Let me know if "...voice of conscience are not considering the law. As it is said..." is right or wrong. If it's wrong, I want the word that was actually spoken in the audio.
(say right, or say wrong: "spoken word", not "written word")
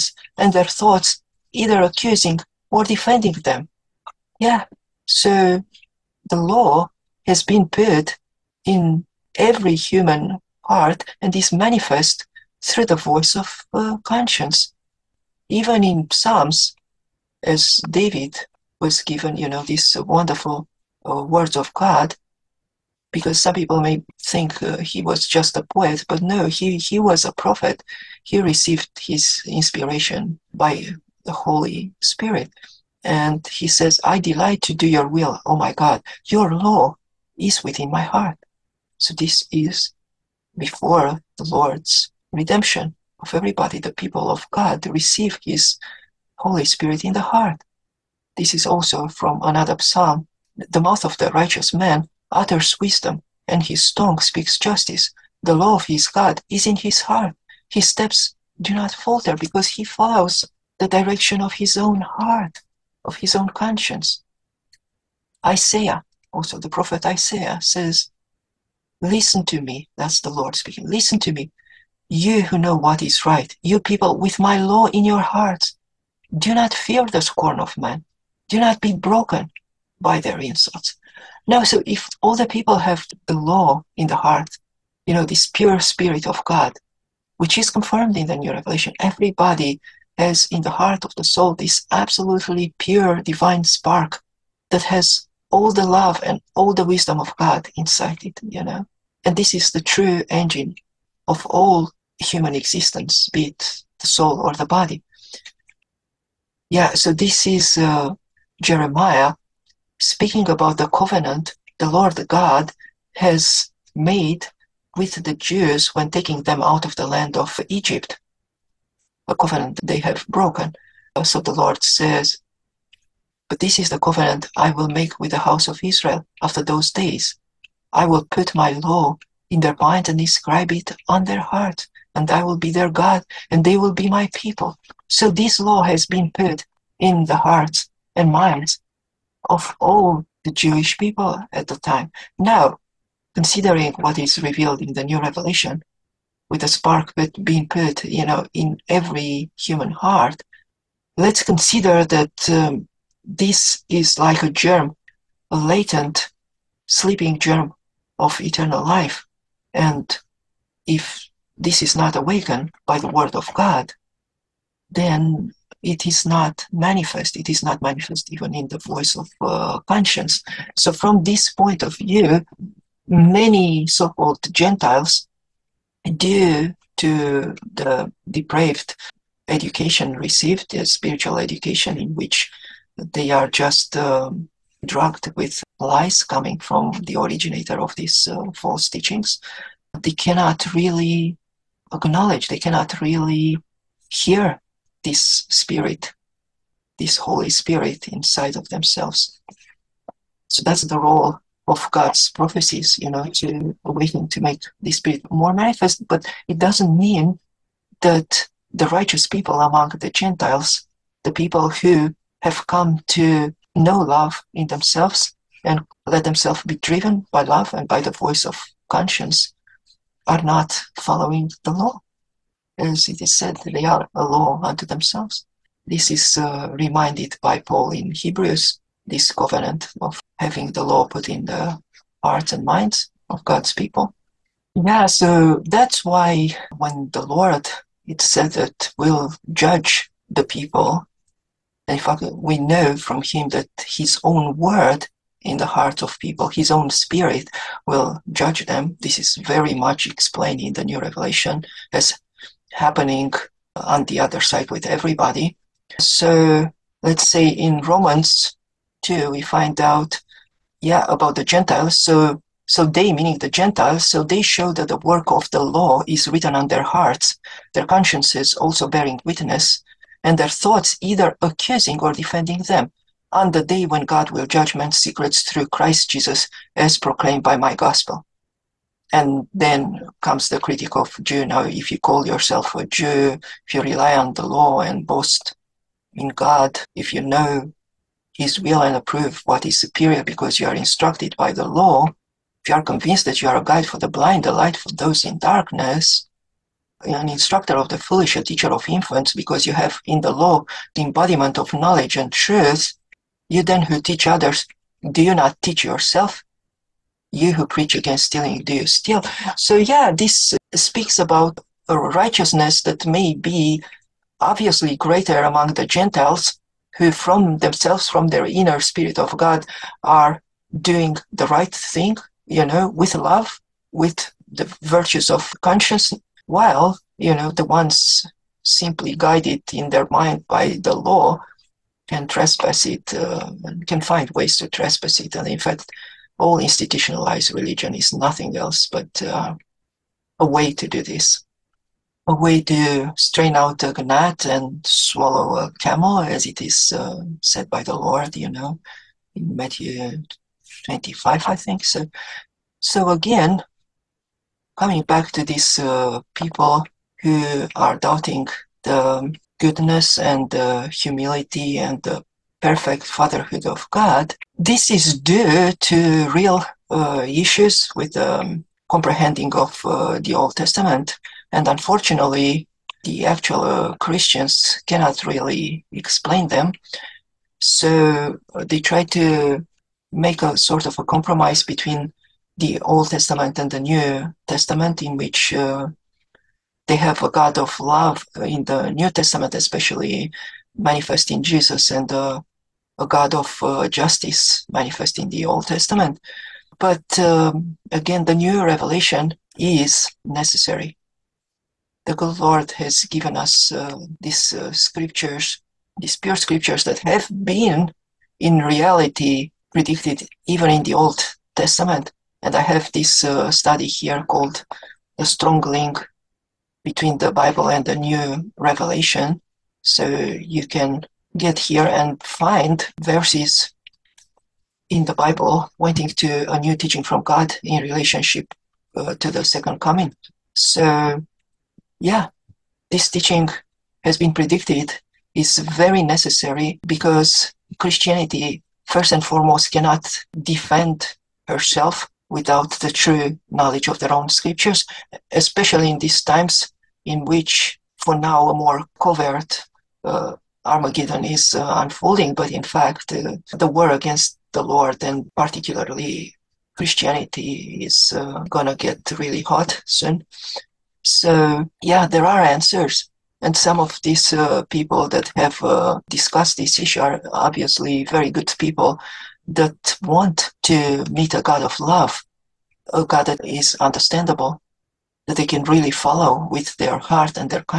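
wrong: "following", not "considering".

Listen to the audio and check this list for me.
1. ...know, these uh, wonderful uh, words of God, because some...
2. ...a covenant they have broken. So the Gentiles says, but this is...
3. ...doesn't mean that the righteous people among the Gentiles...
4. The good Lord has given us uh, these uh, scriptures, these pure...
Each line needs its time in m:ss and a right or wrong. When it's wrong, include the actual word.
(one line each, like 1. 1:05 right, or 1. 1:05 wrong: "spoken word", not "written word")
1. 0:19 right
2. 1:59 wrong: "Lord", not "Gentiles"
3. 3:26 right
4. 6:42 right.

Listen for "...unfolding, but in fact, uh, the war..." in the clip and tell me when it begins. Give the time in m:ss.
7:31.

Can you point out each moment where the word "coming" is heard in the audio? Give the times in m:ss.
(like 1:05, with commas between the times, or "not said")
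3:06, 5:54, 7:09.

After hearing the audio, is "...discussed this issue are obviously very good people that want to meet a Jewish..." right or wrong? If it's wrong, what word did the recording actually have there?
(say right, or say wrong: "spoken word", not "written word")
wrong: "God", not "Jewish".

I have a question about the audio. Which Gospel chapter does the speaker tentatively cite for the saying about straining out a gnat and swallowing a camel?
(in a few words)
Matthew 25.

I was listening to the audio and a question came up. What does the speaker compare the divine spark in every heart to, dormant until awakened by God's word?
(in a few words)
A latent sleeping germ.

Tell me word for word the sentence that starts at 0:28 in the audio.
He received his inspiration by the Holy Spirit.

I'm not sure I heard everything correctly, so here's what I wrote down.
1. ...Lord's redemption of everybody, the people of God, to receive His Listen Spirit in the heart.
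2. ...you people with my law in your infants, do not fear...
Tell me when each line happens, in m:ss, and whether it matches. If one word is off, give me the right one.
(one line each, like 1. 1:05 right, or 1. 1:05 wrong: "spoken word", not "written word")
1. 0:41 wrong: "Holy", not "Listen"
2. 1:13 wrong: "hearts", not "infants".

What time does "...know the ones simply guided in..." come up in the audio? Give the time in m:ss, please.
5:27.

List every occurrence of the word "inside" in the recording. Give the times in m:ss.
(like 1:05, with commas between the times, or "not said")
1:37, 3:18.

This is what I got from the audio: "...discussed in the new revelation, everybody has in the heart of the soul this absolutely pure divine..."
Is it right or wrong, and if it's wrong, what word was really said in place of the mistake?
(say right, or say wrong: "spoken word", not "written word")
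wrong: "confirmed", not "discussed".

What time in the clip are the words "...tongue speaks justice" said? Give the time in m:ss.
0:53.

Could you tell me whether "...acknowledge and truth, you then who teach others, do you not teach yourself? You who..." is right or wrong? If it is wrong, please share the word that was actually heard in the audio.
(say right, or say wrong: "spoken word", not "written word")
wrong: "knowledge", not "acknowledge".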